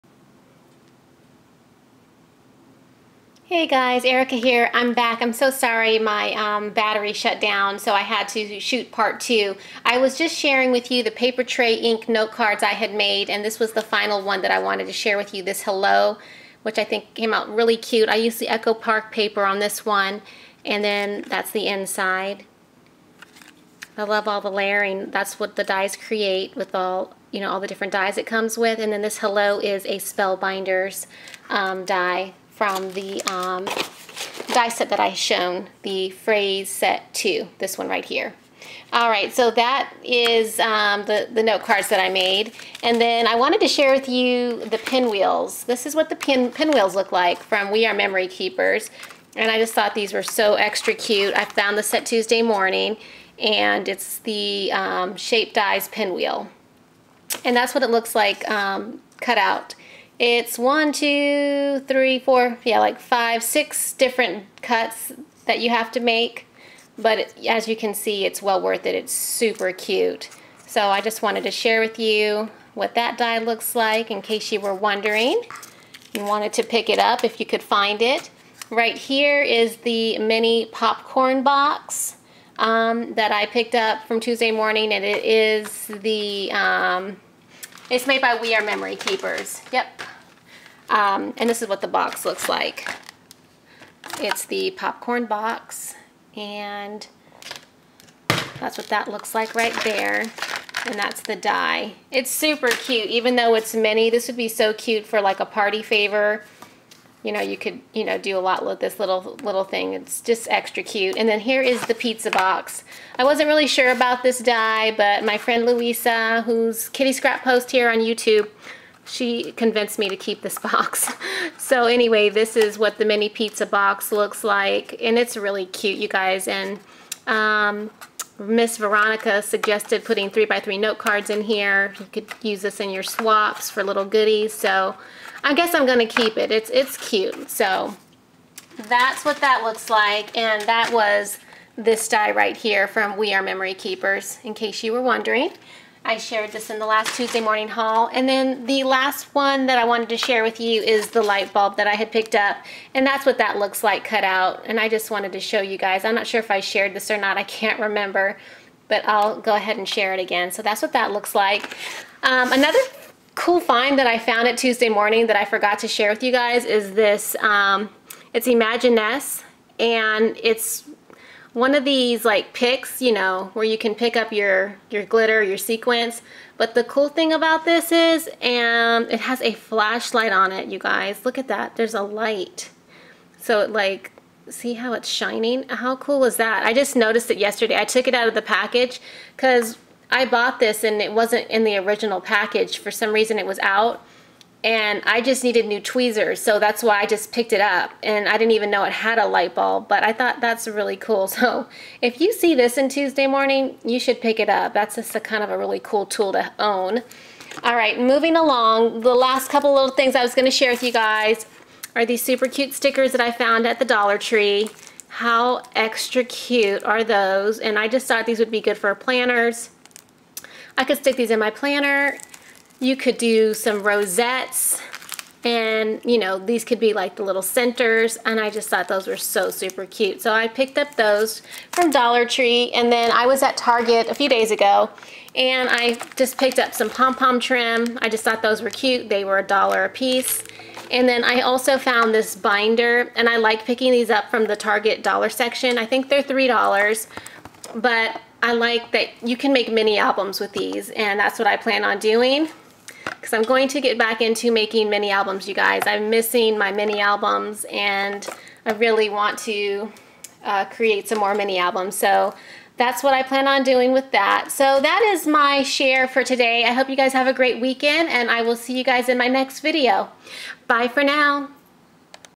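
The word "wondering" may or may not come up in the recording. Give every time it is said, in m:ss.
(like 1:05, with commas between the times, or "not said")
1:14, 2:25.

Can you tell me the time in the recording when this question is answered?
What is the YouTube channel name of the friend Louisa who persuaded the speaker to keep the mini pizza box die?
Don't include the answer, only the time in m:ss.
1:56.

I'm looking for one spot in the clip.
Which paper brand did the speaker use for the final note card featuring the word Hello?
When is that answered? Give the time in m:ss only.
0:18.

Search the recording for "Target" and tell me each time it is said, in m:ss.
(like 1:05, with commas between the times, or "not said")
3:53, 4:04.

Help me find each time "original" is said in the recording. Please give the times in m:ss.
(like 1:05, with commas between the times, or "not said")
3:11.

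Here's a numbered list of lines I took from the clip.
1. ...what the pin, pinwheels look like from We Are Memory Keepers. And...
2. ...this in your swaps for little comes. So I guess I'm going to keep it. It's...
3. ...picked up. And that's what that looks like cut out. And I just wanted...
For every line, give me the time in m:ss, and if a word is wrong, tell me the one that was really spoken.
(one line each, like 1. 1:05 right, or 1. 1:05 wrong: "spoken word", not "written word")
1. 0:45 right
2. 2:12 wrong: "goodies", not "comes"
3. 2:32 right.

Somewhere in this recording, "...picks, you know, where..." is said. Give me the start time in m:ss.
2:52.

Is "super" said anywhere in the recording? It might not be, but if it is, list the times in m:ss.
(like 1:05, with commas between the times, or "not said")
1:09, 1:42, 3:32, 3:49.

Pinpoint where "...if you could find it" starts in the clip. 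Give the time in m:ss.
1:17.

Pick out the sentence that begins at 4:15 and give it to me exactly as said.
I'm missing my mini albums and I really want to uh, create some more mini albums.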